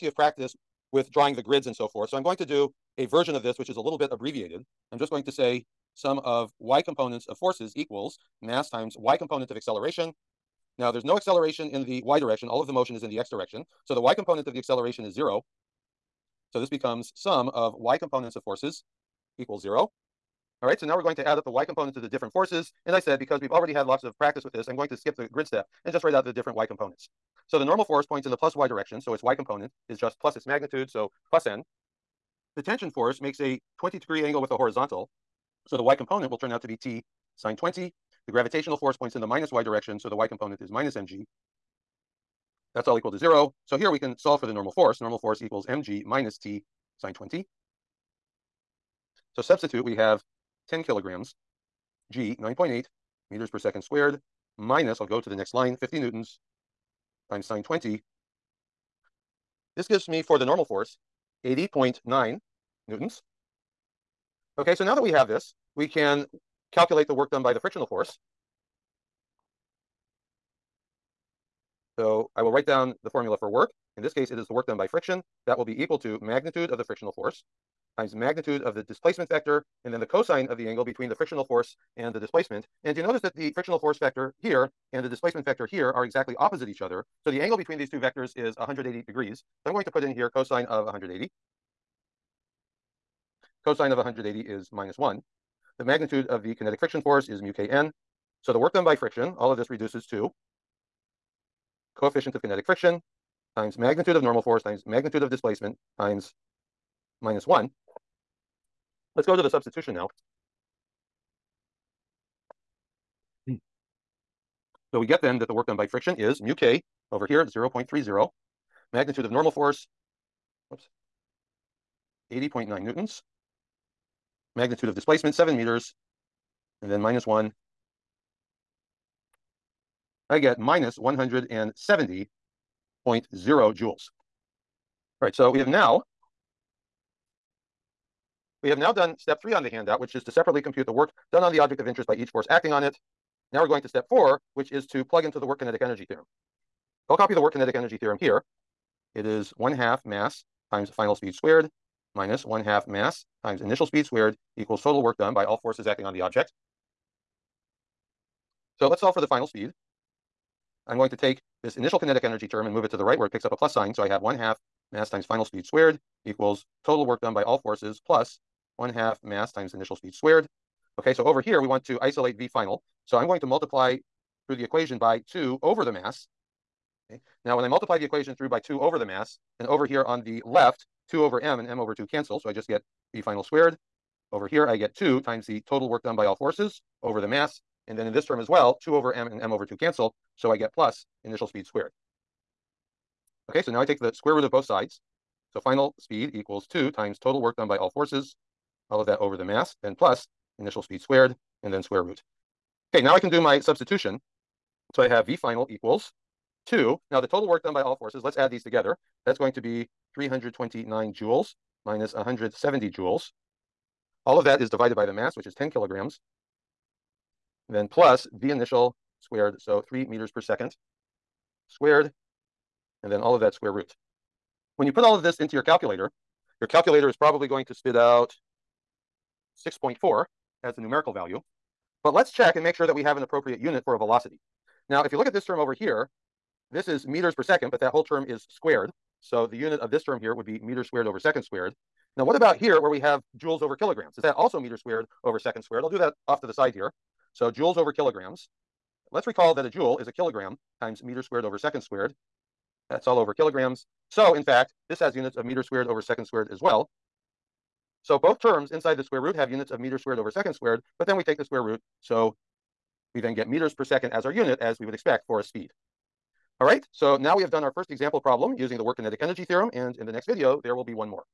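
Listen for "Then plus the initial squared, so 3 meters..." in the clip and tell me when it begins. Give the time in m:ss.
3:37.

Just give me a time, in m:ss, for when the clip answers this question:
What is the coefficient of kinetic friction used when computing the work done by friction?
1:57.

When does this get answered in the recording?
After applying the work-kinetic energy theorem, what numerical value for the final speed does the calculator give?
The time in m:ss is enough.
3:49.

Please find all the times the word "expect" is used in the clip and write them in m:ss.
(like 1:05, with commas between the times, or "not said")
4:24.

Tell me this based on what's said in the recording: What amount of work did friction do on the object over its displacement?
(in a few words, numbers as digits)
-170.0 joules.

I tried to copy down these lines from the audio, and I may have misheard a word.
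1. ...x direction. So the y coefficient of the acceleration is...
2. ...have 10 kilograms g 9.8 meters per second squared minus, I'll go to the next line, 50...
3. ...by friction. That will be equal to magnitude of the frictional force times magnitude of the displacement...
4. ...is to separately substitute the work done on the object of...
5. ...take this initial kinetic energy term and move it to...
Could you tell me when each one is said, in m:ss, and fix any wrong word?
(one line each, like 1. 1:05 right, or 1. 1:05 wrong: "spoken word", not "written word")
1. 0:13 wrong: "component", not "coefficient"
2. 0:49 right
3. 1:14 right
4. 2:20 wrong: "compute", not "substitute"
5. 2:41 right.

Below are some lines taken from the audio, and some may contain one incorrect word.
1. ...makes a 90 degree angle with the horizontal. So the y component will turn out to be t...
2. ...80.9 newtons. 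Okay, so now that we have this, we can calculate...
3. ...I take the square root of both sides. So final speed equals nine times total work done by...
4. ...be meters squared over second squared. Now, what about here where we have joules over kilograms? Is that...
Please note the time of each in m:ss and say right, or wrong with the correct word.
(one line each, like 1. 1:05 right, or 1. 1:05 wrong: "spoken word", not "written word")
1. 0:33 wrong: "20", not "90"
2. 1:01 right
3. 3:13 wrong: "two", not "nine"
4. 4:00 right.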